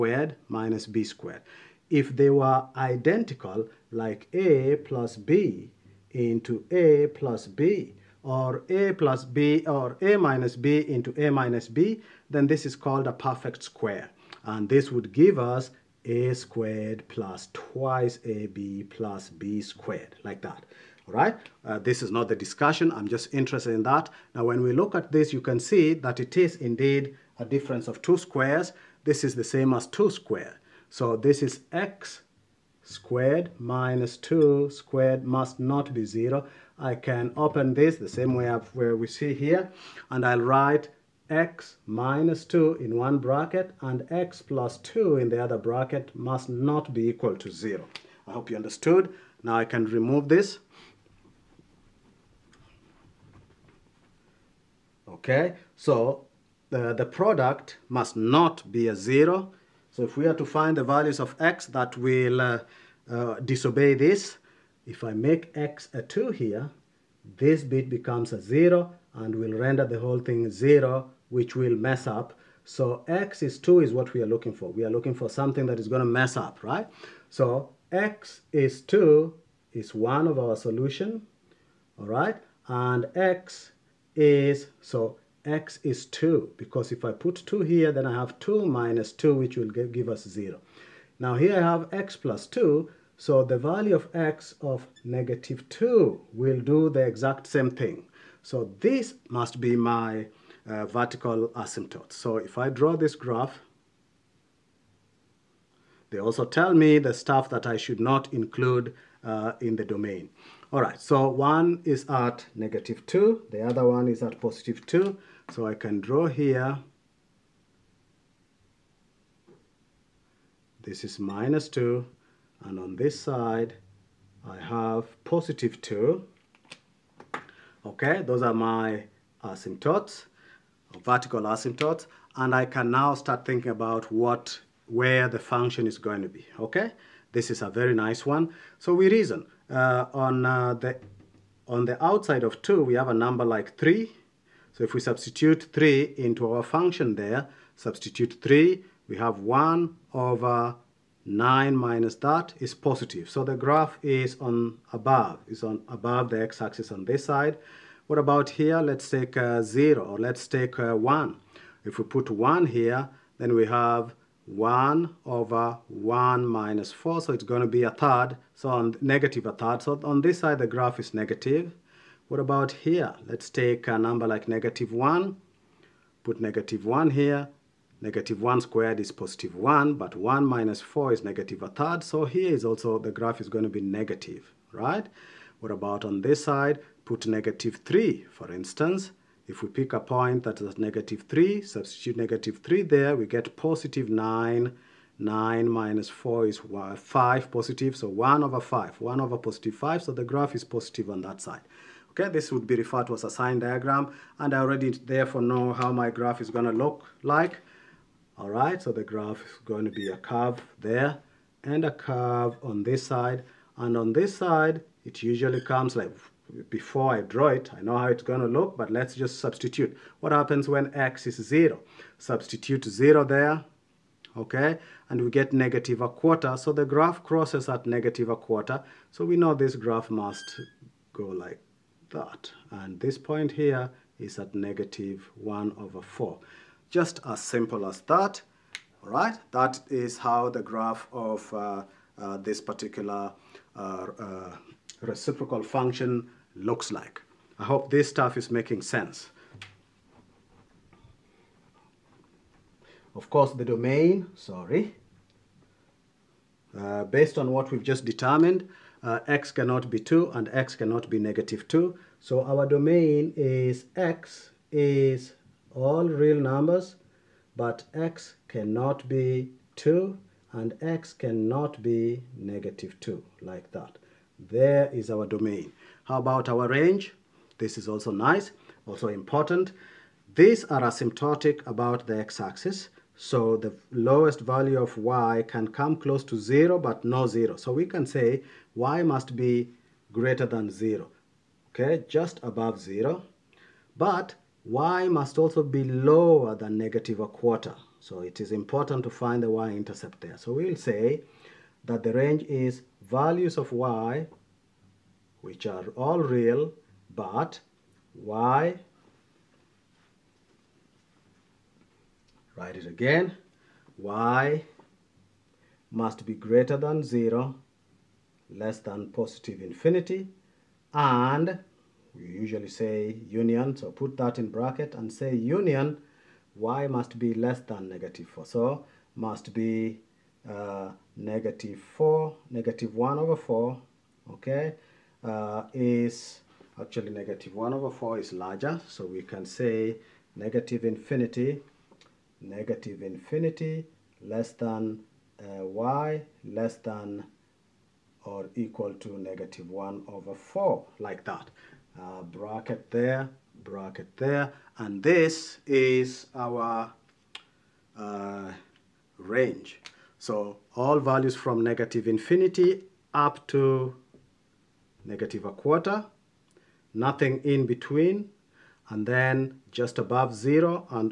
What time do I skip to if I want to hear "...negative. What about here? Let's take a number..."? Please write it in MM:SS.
02:51.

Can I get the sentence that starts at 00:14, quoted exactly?
And this would give us a squared plus twice ab plus b squared, like that.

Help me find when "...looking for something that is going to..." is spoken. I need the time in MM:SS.
01:14.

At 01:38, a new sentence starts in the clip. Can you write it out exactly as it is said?
So this must be my uh, vertical asymptote.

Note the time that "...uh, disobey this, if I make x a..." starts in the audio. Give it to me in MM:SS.
01:03.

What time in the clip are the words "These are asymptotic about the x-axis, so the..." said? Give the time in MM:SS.
04:40.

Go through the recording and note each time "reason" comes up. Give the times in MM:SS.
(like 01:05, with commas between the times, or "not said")
02:19.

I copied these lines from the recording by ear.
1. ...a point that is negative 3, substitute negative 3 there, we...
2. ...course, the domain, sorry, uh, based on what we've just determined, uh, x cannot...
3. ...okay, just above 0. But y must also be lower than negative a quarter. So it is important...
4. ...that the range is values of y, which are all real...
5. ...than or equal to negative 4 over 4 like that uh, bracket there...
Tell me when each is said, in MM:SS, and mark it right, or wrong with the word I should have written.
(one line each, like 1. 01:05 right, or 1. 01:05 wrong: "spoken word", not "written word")
1. 03:09 right
2. 04:13 right
3. 04:51 right
4. 05:01 right
5. 05:46 wrong: "1", not "4".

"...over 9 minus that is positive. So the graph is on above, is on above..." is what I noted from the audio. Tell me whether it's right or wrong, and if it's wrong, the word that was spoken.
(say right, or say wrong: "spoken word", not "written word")
right.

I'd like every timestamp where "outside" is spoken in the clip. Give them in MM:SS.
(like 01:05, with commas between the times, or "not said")
02:22.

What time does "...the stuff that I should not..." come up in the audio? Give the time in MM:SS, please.
01:46.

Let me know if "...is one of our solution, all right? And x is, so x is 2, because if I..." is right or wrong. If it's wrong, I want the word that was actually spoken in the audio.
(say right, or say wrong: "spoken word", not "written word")
right.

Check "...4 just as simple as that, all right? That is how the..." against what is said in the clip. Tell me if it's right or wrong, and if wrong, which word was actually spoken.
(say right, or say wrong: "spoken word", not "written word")
right.